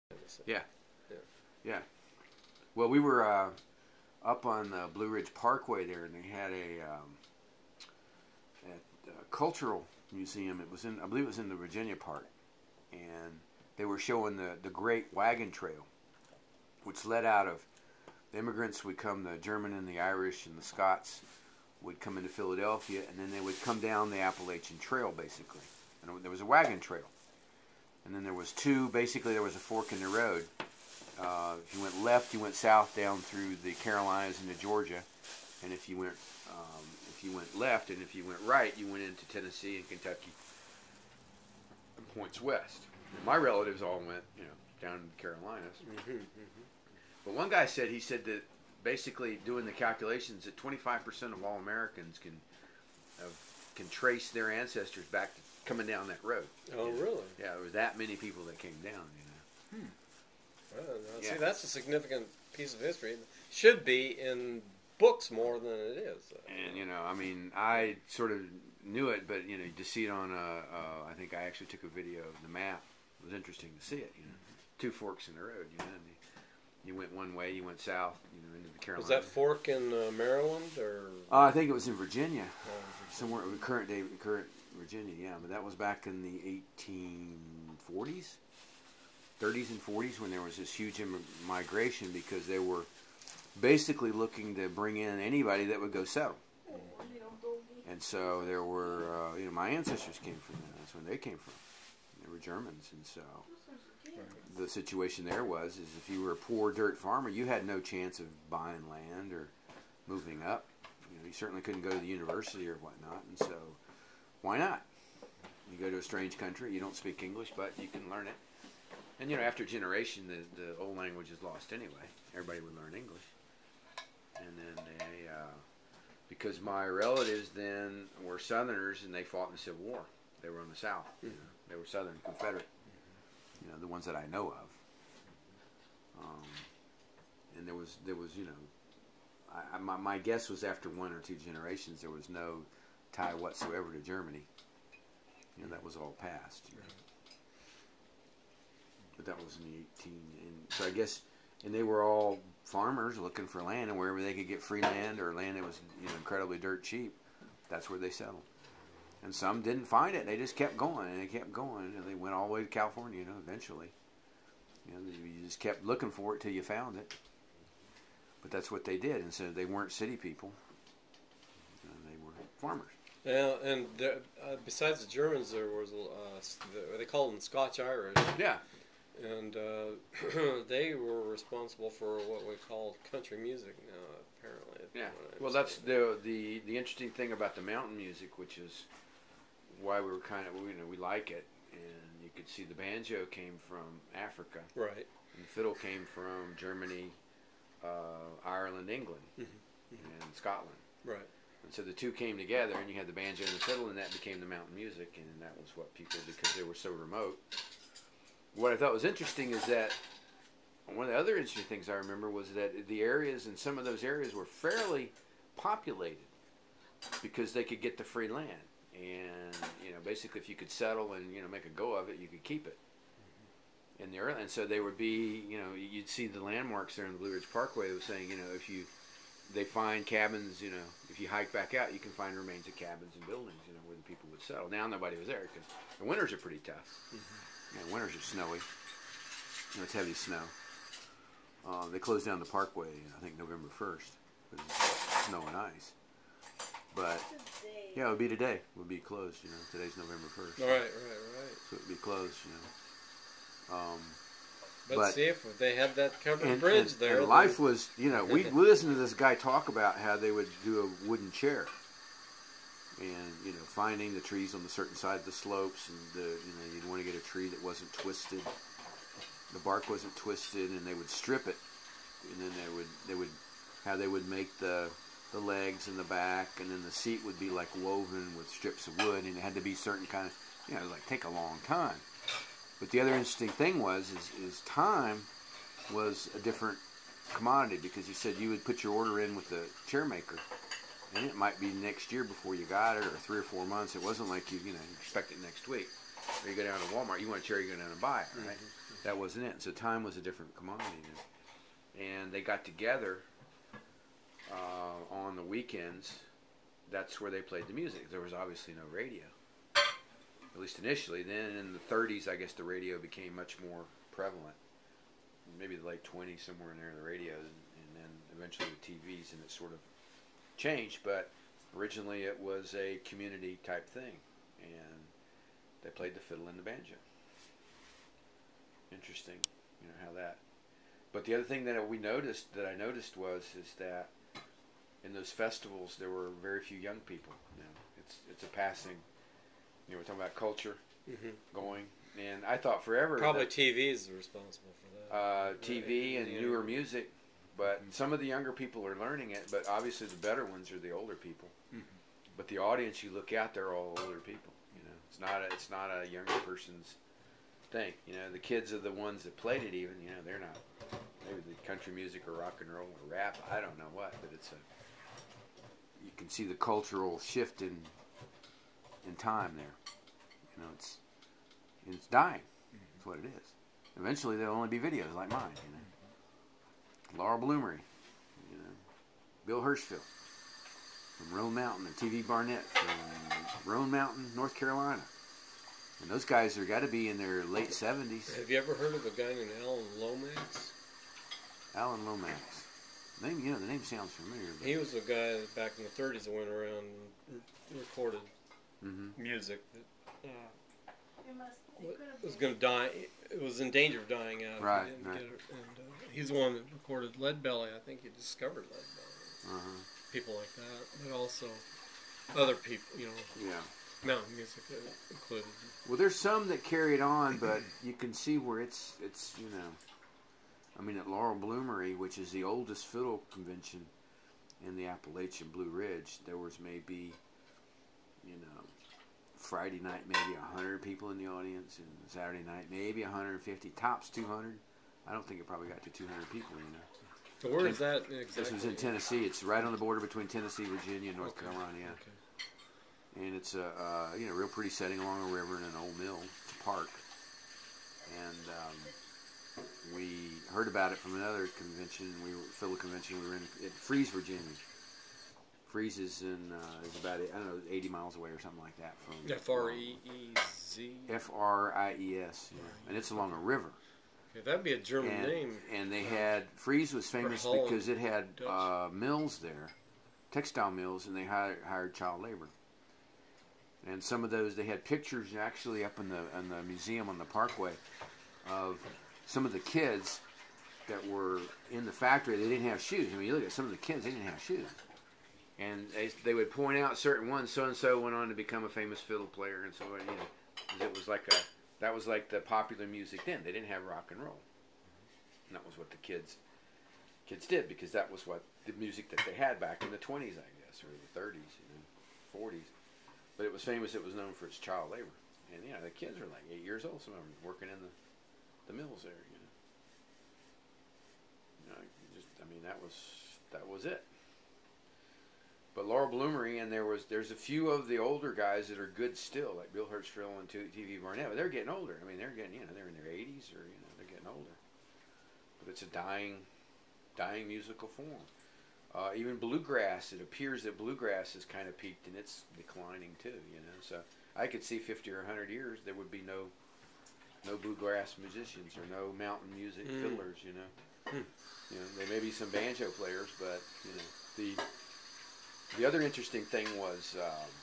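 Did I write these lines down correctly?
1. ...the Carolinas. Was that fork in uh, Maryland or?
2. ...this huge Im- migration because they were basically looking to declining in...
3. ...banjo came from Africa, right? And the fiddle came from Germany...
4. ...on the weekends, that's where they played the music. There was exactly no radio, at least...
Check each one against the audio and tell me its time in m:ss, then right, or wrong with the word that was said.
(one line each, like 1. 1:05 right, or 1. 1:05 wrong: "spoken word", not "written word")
1. 1:18 right
2. 1:30 wrong: "bring", not "declining"
3. 3:12 right
4. 5:05 wrong: "obviously", not "exactly".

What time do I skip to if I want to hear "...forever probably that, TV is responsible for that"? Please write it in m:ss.
5:42.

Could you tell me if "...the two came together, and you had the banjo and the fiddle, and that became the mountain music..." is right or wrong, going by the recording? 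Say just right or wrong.
right.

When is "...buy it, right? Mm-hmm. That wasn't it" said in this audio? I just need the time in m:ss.
4:58.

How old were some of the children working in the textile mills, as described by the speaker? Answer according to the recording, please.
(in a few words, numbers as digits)
8 years old.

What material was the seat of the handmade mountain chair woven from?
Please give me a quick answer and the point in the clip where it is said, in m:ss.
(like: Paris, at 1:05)
Strips of wood, at 4:38.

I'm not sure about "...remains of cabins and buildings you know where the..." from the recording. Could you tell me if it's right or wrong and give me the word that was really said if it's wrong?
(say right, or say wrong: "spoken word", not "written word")
right.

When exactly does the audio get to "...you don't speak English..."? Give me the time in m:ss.
1:56.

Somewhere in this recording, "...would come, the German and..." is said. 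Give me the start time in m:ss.
0:18.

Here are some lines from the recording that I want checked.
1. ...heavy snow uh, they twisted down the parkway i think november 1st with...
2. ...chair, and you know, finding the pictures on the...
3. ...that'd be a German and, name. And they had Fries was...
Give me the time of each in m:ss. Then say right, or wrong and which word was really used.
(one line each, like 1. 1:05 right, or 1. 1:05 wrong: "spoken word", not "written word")
1. 3:59 wrong: "closed", not "twisted"
2. 4:21 wrong: "trees", not "pictures"
3. 7:44 right.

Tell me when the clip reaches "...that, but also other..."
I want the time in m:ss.
6:50.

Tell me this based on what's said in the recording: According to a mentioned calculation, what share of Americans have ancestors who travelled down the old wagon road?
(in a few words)
25%.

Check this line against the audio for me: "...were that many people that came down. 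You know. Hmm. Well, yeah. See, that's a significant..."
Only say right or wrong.
right.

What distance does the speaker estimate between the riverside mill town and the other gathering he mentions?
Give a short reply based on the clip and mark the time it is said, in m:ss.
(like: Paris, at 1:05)
80 miles, at 7:37.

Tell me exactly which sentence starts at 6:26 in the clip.
And those guys are got to be in their late 70s.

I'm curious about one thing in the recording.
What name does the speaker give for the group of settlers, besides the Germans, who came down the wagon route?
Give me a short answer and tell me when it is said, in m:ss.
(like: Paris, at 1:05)
Scotch Irish, at 2:57.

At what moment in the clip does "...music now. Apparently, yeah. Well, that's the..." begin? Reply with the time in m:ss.
3:03.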